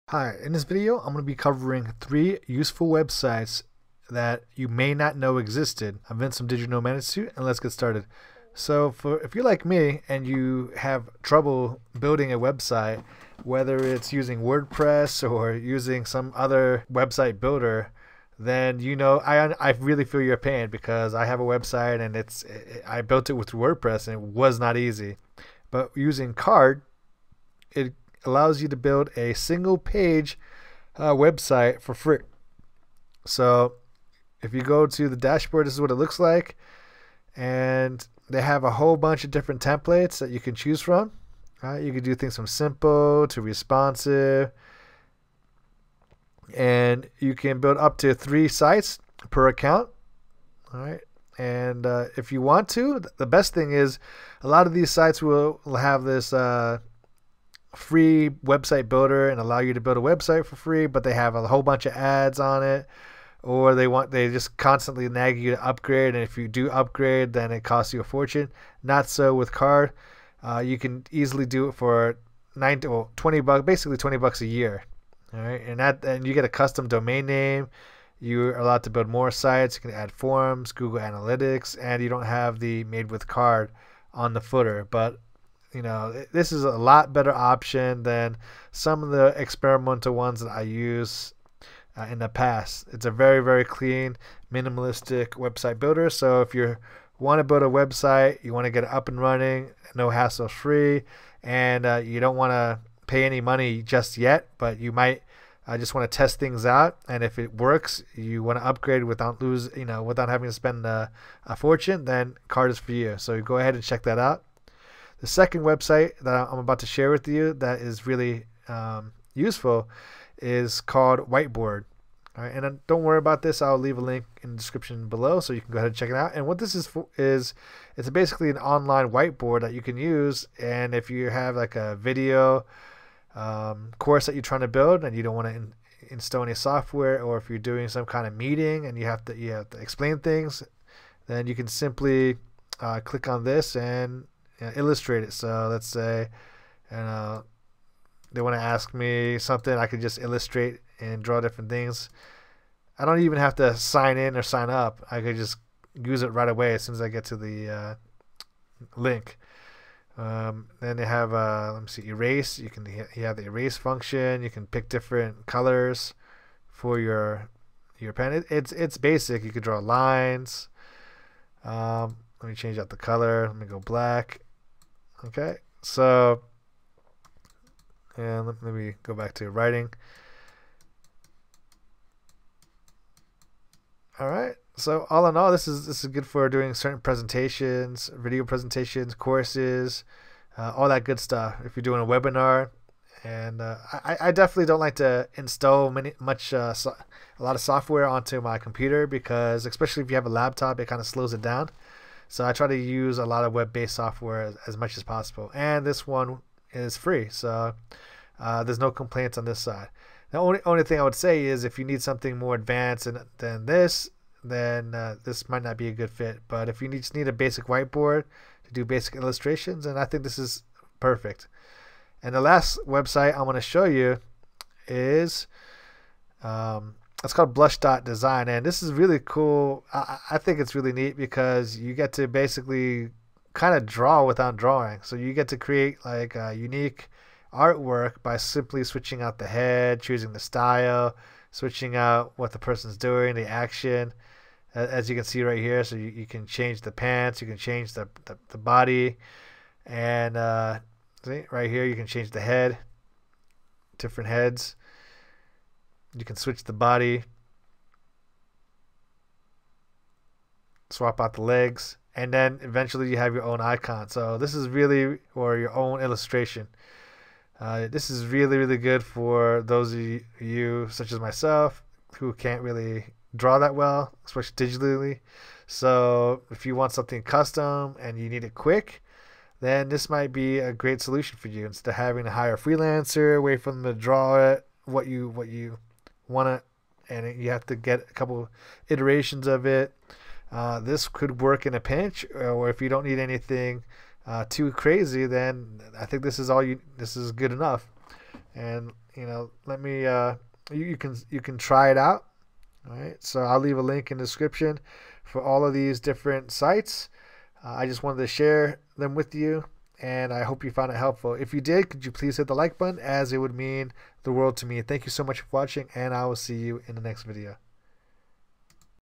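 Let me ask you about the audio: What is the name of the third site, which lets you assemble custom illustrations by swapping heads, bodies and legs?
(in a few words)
Blush Dot Design.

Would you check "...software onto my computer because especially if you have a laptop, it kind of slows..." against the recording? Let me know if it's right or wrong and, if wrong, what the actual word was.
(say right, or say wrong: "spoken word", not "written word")
right.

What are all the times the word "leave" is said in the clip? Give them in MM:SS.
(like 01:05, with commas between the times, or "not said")
02:03, 05:03.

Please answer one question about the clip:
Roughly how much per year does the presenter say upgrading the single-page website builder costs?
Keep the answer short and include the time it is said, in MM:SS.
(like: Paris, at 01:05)
$20, at 01:13.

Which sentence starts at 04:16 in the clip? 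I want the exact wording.
You can switch the body, swap out the legs, and then eventually you have your own icon.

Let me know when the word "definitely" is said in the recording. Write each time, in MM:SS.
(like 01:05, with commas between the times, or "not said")
03:14.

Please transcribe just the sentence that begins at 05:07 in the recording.
Uh, I just wanted to share them with you and I hope you found it helpful.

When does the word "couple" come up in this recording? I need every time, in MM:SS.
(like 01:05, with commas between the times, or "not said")
04:48.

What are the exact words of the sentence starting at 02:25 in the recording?
So let's say, you uh, know, they want to ask me something, I could just illustrate and draw different things.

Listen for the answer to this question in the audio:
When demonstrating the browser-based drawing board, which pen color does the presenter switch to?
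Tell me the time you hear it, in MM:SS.
02:53.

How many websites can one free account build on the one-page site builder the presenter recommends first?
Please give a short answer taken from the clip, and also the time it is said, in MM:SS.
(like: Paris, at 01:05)
3, at 00:48.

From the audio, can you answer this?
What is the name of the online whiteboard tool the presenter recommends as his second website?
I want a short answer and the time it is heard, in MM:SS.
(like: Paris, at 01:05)
Witeboard, at 02:01.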